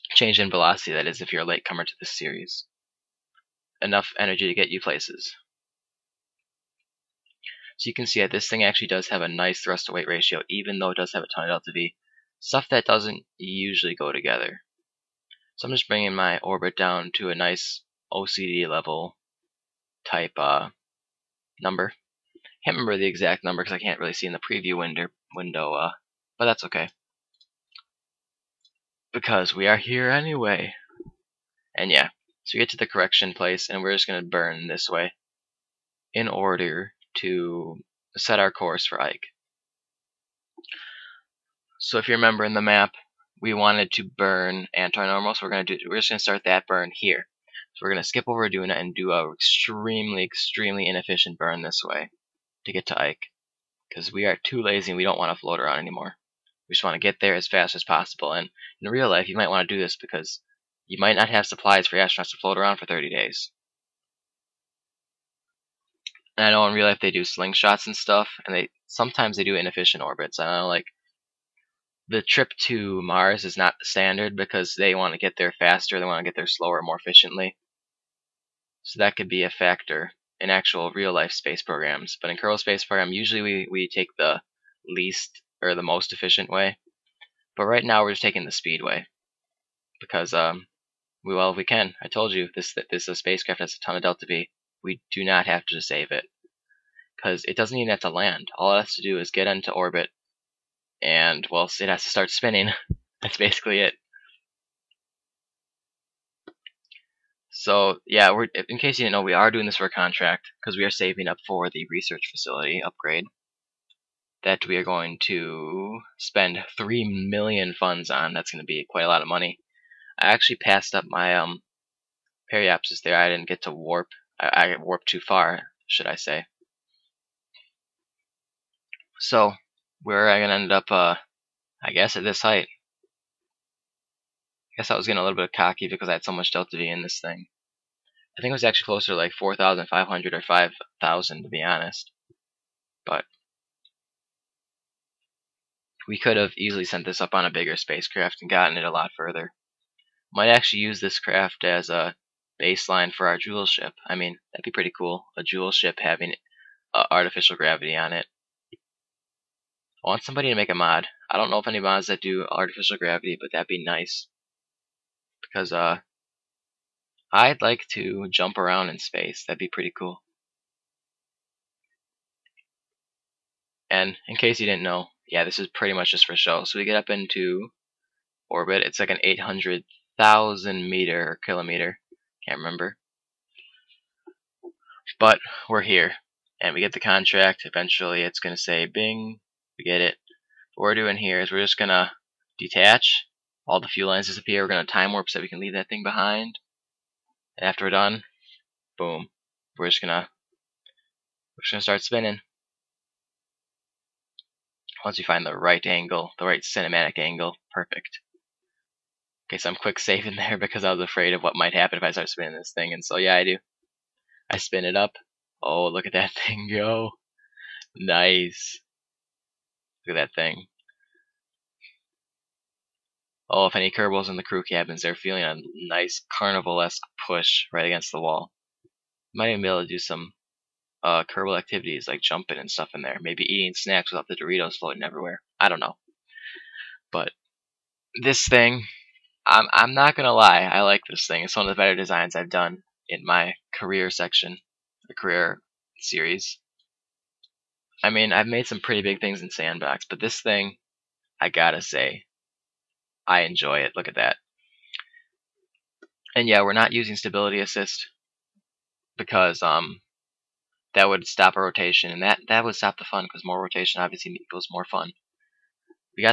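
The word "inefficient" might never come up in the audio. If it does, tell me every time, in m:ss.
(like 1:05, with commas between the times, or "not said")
0:50, 1:09.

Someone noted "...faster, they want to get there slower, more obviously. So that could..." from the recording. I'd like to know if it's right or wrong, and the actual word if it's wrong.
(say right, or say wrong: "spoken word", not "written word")
wrong: "efficiently", not "obviously".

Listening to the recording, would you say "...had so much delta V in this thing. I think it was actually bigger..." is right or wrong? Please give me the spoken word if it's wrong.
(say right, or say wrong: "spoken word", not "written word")
wrong: "closer", not "bigger".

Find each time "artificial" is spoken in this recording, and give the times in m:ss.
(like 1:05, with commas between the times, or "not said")
2:37, 2:42.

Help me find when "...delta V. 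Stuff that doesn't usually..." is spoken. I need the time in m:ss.
0:11.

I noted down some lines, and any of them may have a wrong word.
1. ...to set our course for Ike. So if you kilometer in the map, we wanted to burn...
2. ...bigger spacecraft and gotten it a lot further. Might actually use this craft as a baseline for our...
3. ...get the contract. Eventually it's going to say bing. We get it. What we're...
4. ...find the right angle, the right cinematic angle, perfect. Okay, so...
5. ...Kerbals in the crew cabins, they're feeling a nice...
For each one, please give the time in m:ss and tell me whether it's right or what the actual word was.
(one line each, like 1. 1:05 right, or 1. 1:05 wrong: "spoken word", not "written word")
1. 0:37 wrong: "remember", not "kilometer"
2. 2:27 right
3. 3:06 right
4. 3:25 right
5. 3:43 right.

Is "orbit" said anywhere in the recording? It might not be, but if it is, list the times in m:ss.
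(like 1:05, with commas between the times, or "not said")
0:16, 1:10, 1:39, 2:58.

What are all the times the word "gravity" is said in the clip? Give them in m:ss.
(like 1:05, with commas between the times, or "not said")
2:37, 2:42.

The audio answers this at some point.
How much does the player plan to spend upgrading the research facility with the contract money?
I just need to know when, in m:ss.
1:56.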